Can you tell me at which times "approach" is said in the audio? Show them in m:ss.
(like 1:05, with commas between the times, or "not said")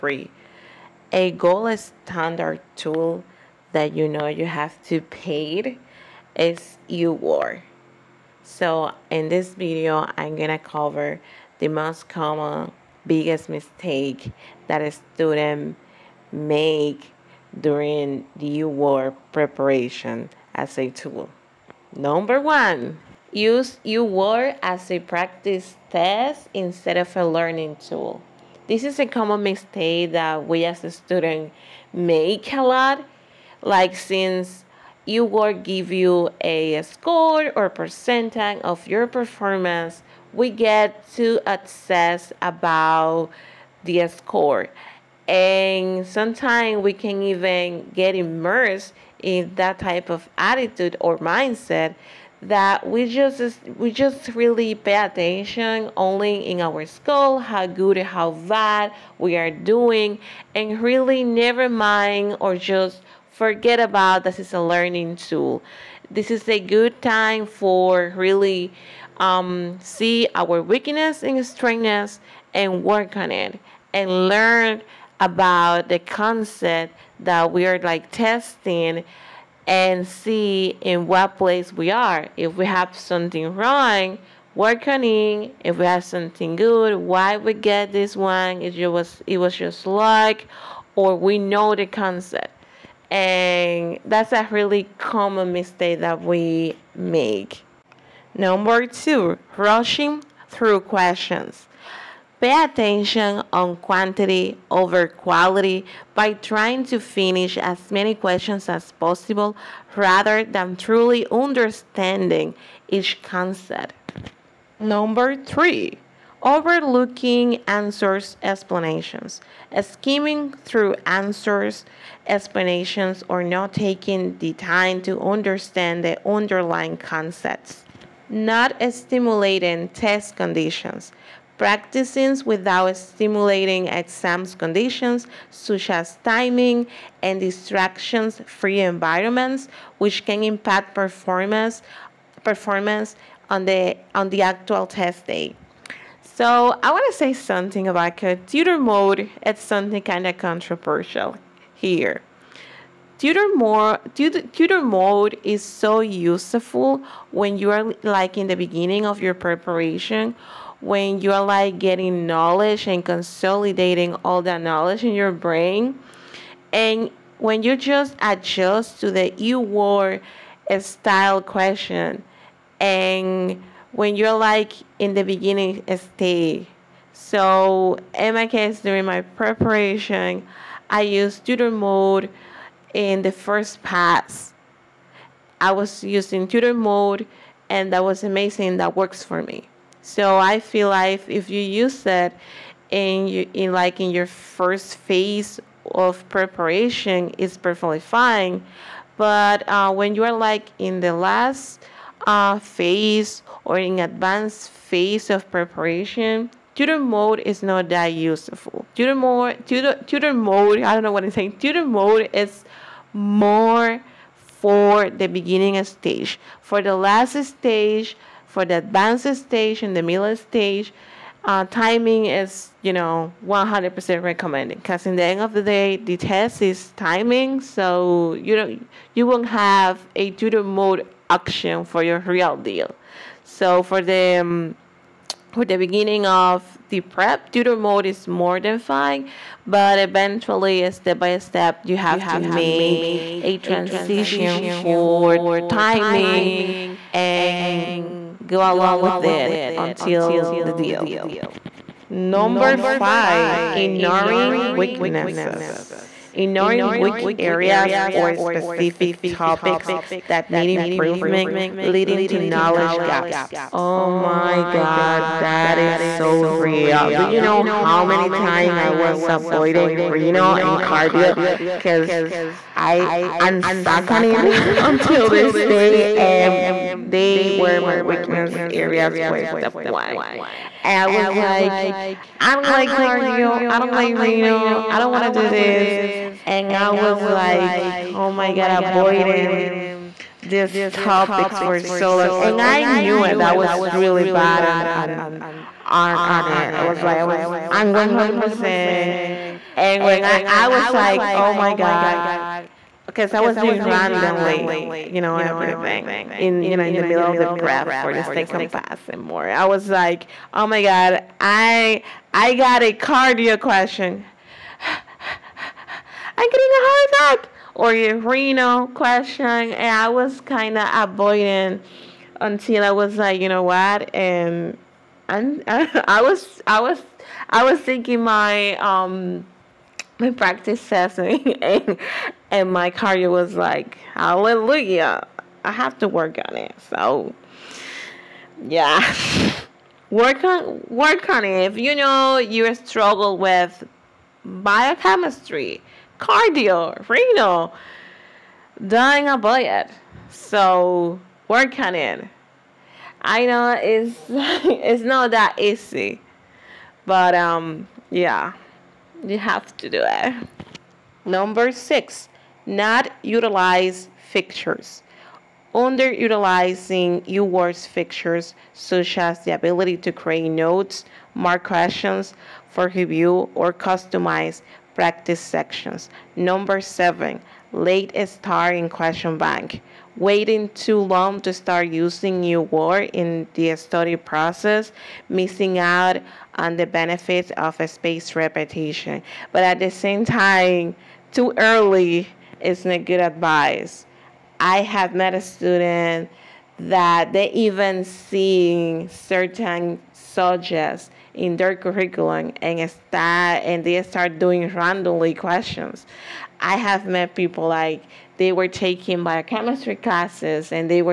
not said.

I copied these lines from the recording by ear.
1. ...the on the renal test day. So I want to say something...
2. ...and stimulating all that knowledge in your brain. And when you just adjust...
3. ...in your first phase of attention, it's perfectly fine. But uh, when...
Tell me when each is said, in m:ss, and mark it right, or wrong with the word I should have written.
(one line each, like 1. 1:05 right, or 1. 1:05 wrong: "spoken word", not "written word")
1. 2:23 wrong: "actual", not "renal"
2. 2:42 wrong: "consolidating", not "stimulating"
3. 3:13 wrong: "preparation", not "attention".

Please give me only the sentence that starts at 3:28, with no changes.
Tutor mode, tutor, tutor mode, I don't know what I'm saying.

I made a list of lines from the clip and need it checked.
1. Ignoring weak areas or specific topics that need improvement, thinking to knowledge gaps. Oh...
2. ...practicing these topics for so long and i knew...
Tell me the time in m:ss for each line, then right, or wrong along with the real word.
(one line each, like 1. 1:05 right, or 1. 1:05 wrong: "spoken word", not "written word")
1. 4:16 wrong: "leading", not "thinking"
2. 4:48 wrong: "avoiding", not "practicing".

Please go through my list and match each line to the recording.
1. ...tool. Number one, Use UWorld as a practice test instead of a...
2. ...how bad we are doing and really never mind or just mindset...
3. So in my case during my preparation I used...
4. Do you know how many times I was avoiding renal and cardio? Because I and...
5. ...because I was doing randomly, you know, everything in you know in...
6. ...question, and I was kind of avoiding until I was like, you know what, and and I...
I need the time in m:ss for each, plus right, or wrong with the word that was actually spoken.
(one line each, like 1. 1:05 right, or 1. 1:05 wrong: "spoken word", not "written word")
1. 0:20 right
2. 0:58 wrong: "forget", not "mindset"
3. 2:57 right
4. 4:27 right
5. 5:03 right
6. 5:18 right.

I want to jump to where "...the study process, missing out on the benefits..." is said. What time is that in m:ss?
6:23.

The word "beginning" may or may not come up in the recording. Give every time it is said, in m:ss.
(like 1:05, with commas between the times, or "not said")
2:38, 2:55, 3:35, 3:55.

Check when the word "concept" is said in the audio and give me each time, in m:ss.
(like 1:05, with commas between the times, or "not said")
1:15, 1:31, 1:53, 2:06.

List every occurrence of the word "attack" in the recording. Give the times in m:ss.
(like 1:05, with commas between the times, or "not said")
5:17.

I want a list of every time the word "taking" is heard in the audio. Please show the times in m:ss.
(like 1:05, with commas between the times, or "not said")
2:03, 6:48.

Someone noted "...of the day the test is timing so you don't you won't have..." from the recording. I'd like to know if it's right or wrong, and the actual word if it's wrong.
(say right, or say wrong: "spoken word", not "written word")
right.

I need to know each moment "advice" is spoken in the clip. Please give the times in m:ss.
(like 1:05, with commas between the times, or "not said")
6:33.